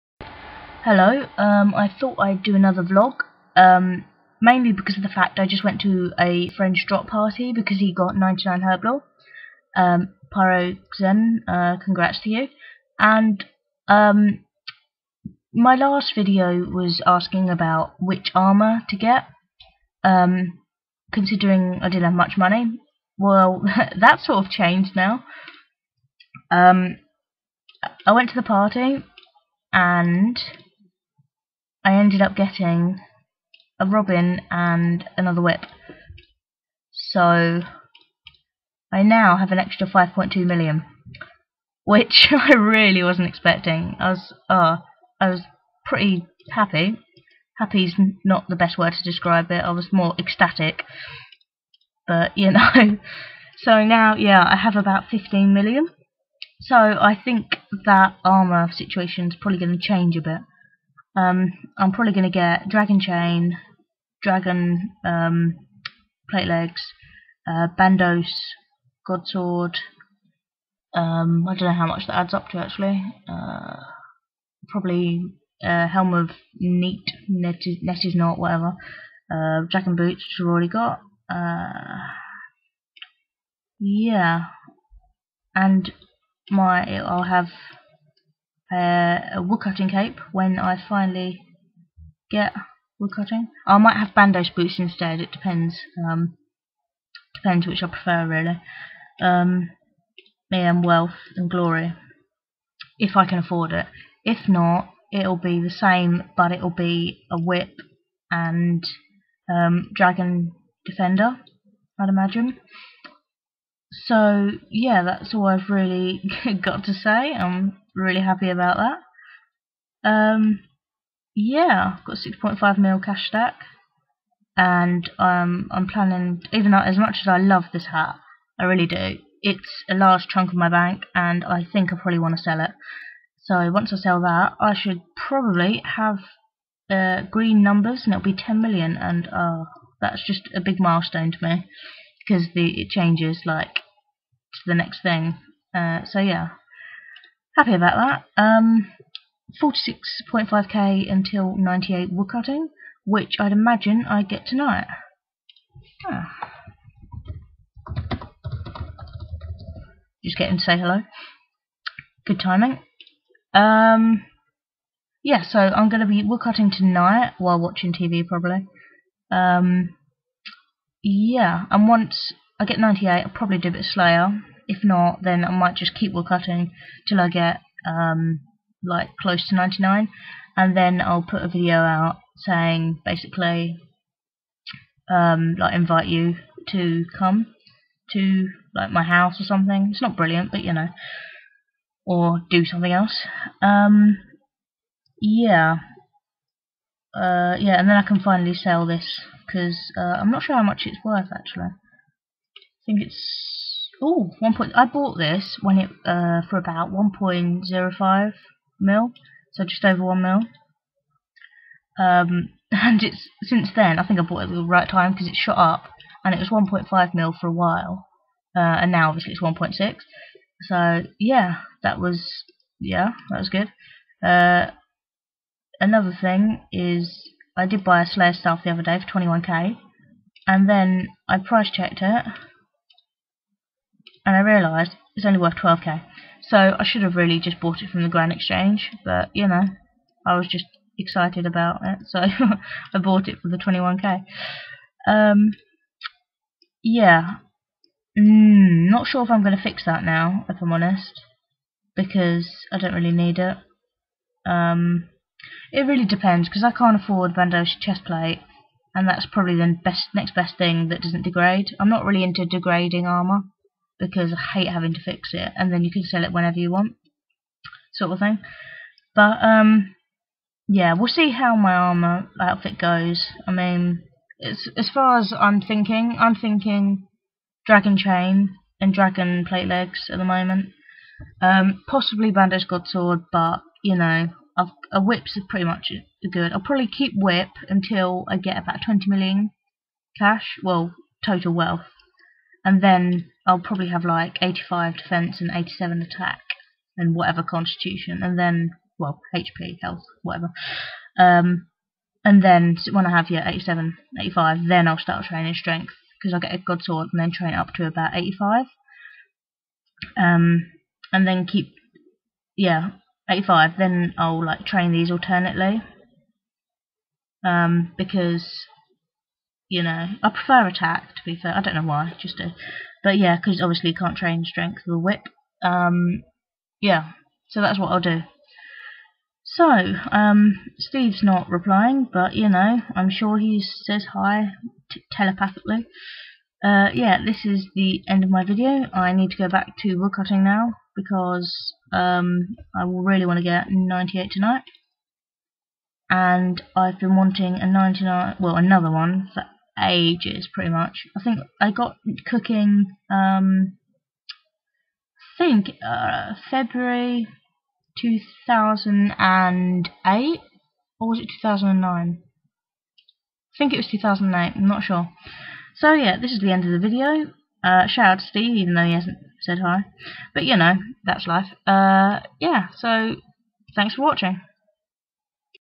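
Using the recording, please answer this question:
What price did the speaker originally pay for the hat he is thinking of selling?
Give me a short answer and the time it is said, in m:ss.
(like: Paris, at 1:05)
1.05 mil, at 3:26.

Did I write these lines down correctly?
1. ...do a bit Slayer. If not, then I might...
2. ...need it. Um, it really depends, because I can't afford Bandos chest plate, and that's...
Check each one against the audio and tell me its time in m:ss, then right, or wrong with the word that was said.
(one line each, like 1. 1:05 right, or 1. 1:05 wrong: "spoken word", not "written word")
1. 2:53 right
2. 4:13 right.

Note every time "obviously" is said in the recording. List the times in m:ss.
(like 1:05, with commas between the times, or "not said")
3:39, 5:23.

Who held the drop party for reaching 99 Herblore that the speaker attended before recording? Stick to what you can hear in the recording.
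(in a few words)
Pyro Zen.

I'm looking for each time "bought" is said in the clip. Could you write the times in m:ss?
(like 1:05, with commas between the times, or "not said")
3:24, 3:34, 3:57, 4:02.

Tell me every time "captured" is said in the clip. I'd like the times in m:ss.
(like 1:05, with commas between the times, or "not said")
not said.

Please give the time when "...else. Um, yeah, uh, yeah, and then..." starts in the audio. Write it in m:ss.
3:12.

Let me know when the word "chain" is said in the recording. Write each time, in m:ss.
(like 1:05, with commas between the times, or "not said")
1:02, 4:37.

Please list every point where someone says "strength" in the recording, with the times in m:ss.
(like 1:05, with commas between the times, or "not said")
5:05, 5:24.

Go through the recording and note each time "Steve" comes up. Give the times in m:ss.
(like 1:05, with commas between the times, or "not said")
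5:30, 6:08.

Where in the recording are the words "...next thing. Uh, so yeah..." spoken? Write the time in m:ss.
2:24.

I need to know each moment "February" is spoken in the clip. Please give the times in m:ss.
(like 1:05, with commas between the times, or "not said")
5:56.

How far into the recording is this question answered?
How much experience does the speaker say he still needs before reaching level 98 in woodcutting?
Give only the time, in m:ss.
2:29.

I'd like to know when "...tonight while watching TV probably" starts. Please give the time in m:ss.
2:46.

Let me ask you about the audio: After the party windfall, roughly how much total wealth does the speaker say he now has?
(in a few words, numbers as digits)
15 million.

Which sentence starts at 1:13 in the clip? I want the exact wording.
Uh, probably uh, Helm of Neat, Net is, Net is Not, whatever.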